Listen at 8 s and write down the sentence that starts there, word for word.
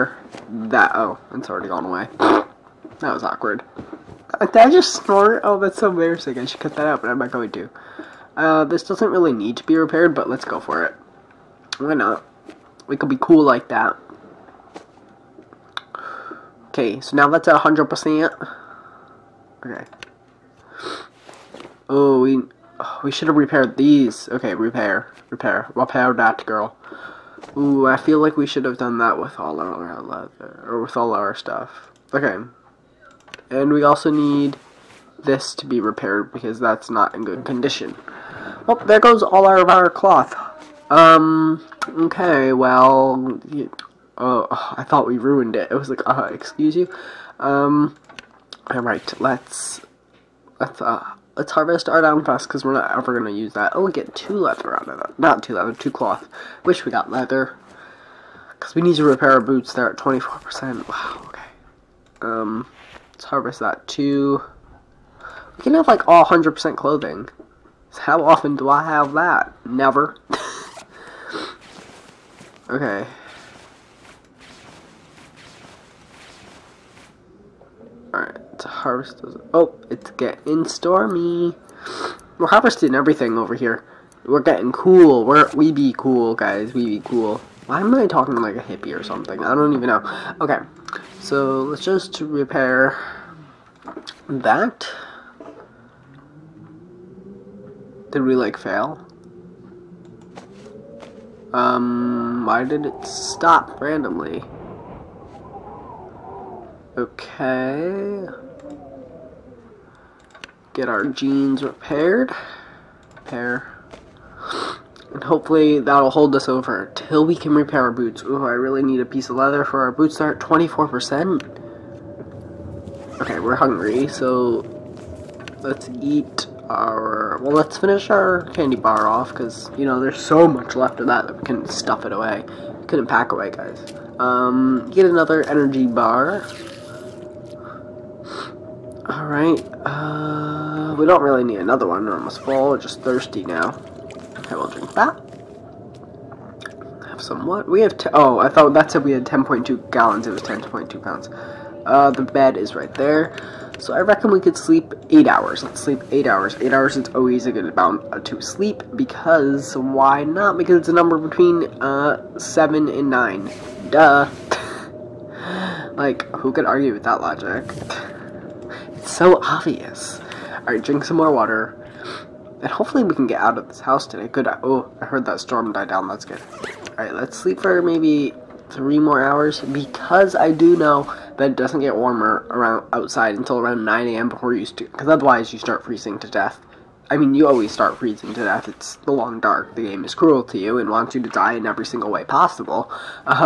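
Uh, this doesn't really need to be repaired, but let's go for it.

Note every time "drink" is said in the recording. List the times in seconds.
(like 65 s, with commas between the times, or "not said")
144 s, 170 s.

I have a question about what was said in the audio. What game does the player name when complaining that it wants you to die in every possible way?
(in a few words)
The Long Dark.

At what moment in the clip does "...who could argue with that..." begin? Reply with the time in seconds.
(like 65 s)
166 s.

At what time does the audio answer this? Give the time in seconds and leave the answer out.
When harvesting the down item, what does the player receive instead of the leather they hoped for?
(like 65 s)
55 s.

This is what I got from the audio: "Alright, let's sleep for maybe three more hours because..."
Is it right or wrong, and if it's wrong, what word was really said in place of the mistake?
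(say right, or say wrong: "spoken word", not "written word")
right.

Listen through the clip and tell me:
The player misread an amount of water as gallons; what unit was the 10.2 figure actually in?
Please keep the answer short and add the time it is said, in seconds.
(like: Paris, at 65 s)
pounds, at 151 s.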